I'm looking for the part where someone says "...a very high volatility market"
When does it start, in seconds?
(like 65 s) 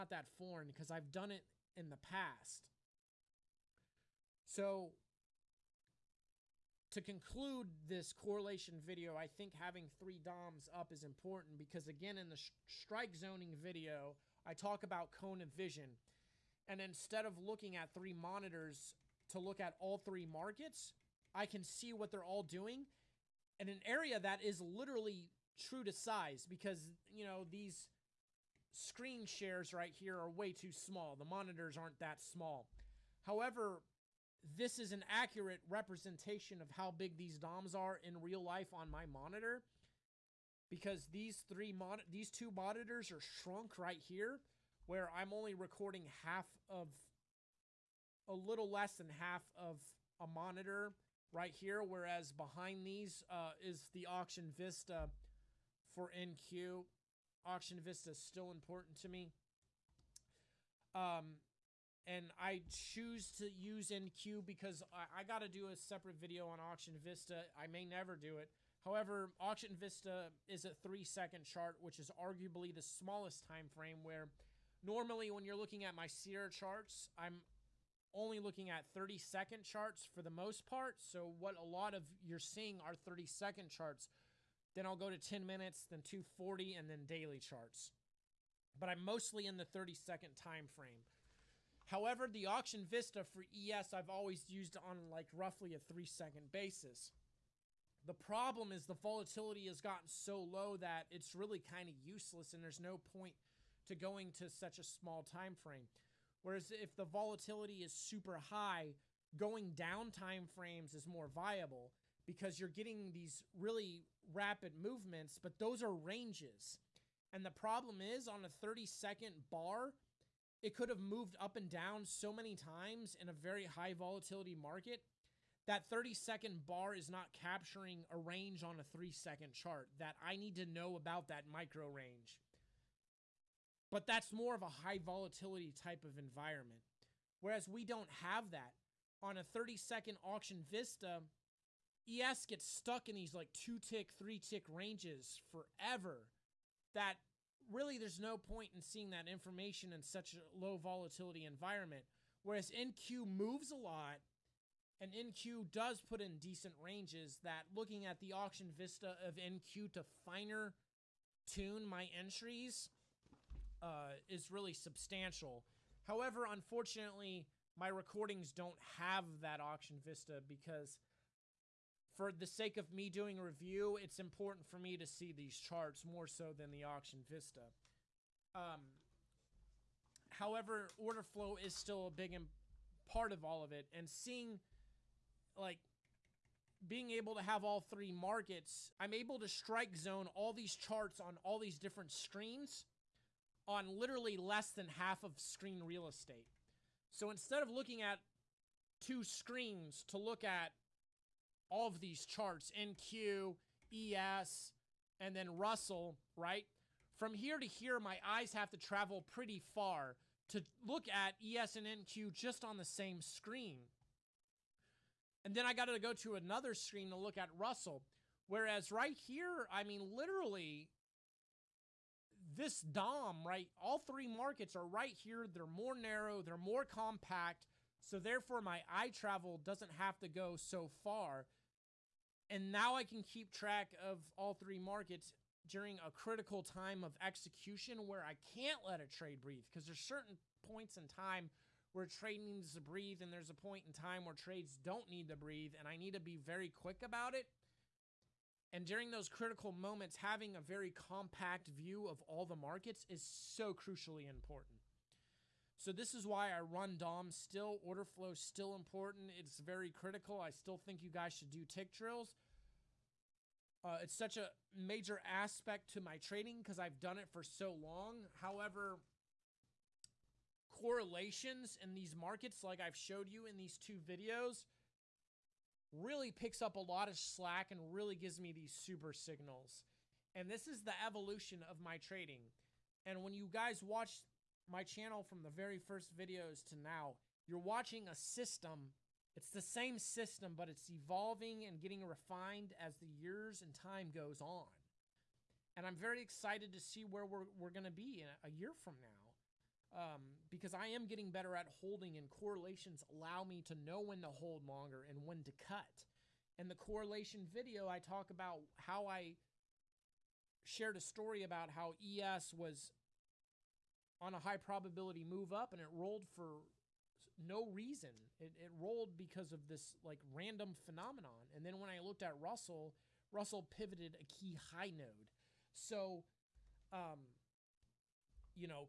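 123 s.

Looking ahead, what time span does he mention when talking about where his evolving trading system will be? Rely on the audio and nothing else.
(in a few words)
a year.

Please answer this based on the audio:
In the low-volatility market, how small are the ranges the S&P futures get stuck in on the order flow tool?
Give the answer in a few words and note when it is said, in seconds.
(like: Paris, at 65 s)
2 to 3 ticks, at 143 s.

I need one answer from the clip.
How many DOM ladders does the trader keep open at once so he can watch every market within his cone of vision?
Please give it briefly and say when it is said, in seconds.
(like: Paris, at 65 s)
3, at 9 s.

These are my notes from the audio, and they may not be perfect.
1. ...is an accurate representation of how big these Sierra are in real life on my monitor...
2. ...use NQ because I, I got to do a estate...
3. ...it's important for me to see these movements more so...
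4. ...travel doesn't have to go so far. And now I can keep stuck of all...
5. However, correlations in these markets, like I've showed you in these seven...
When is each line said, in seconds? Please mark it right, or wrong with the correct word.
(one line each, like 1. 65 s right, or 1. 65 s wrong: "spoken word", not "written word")
1. 34 s wrong: "DOMs", not "Sierra"
2. 63 s wrong: "separate", not "estate"
3. 173 s wrong: "charts", not "movements"
4. 229 s wrong: "track", not "stuck"
5. 268 s wrong: "two", not "seven".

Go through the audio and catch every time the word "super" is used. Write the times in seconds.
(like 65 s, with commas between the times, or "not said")
107 s, 278 s.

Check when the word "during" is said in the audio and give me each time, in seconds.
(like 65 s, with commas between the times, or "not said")
235 s, 248 s.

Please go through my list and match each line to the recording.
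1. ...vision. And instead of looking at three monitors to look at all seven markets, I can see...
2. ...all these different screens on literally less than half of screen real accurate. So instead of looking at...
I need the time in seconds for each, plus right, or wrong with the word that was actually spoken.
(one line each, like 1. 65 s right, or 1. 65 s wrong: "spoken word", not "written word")
1. 15 s wrong: "three", not "seven"
2. 191 s wrong: "estate", not "accurate".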